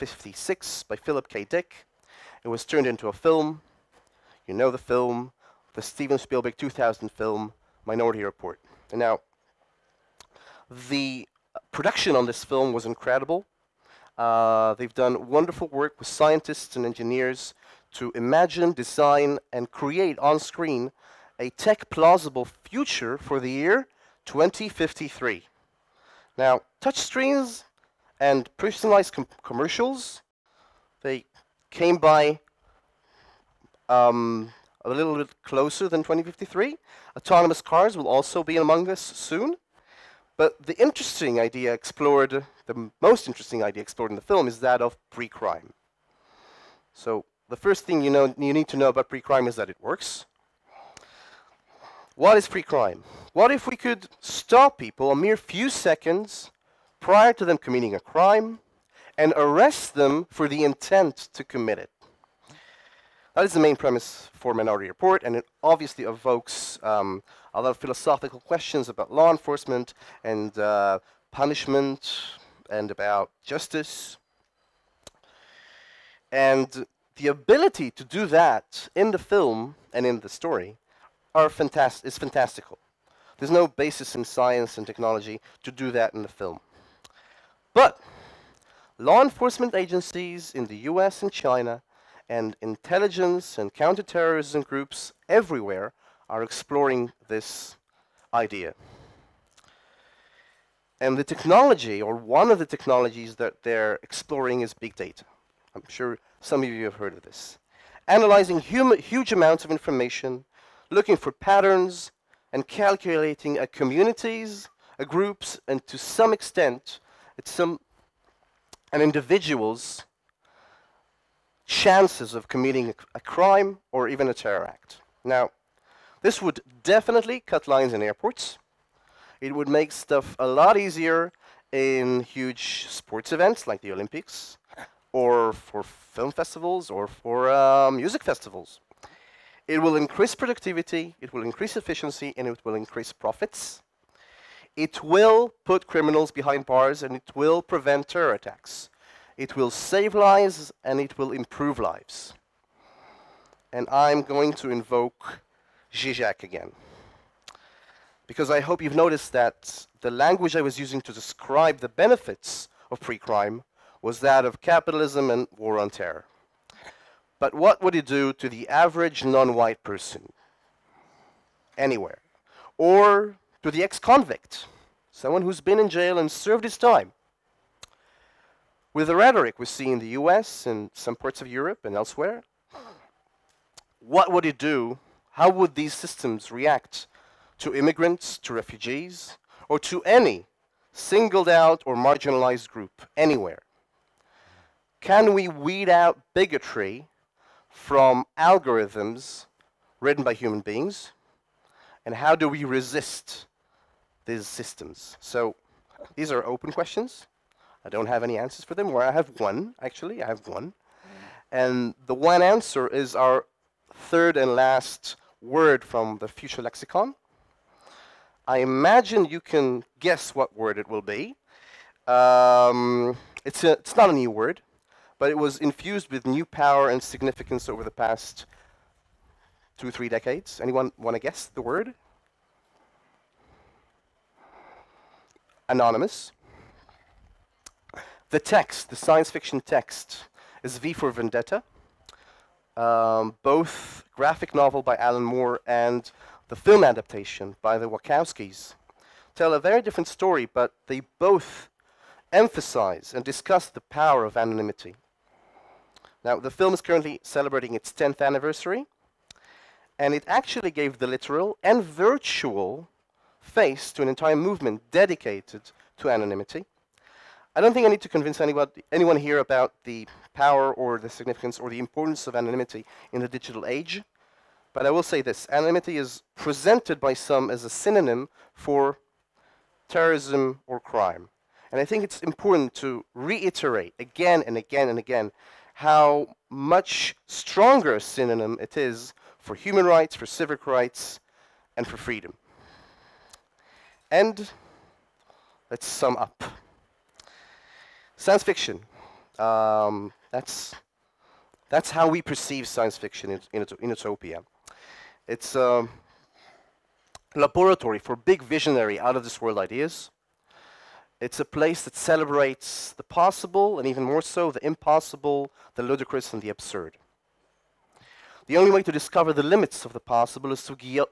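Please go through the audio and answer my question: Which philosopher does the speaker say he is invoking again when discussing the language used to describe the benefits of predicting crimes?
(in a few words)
Zizek.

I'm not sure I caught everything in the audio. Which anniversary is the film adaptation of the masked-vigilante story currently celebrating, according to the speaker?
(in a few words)
10th.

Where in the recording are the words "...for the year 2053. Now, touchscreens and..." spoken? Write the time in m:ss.
0:23.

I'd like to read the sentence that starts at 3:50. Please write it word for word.
Anyone want to guess the word?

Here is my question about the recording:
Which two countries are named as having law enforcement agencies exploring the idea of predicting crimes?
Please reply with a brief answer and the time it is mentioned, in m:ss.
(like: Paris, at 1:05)
US and China, at 1:30.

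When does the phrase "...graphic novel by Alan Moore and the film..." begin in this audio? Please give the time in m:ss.
4:04.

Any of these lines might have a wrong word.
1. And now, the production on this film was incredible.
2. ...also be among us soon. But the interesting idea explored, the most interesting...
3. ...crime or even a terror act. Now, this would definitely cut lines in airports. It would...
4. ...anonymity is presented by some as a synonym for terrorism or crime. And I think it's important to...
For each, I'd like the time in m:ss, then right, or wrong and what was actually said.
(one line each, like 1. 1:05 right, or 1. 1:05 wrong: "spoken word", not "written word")
1. 0:08 right
2. 0:38 right
3. 2:03 right
4. 4:35 right.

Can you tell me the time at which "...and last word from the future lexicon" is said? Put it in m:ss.
3:34.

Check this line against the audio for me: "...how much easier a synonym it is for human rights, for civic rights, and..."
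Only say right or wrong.
wrong.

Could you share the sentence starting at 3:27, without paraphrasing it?
I don't have any answers for them.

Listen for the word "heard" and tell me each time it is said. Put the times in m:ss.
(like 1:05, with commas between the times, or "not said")
1:46.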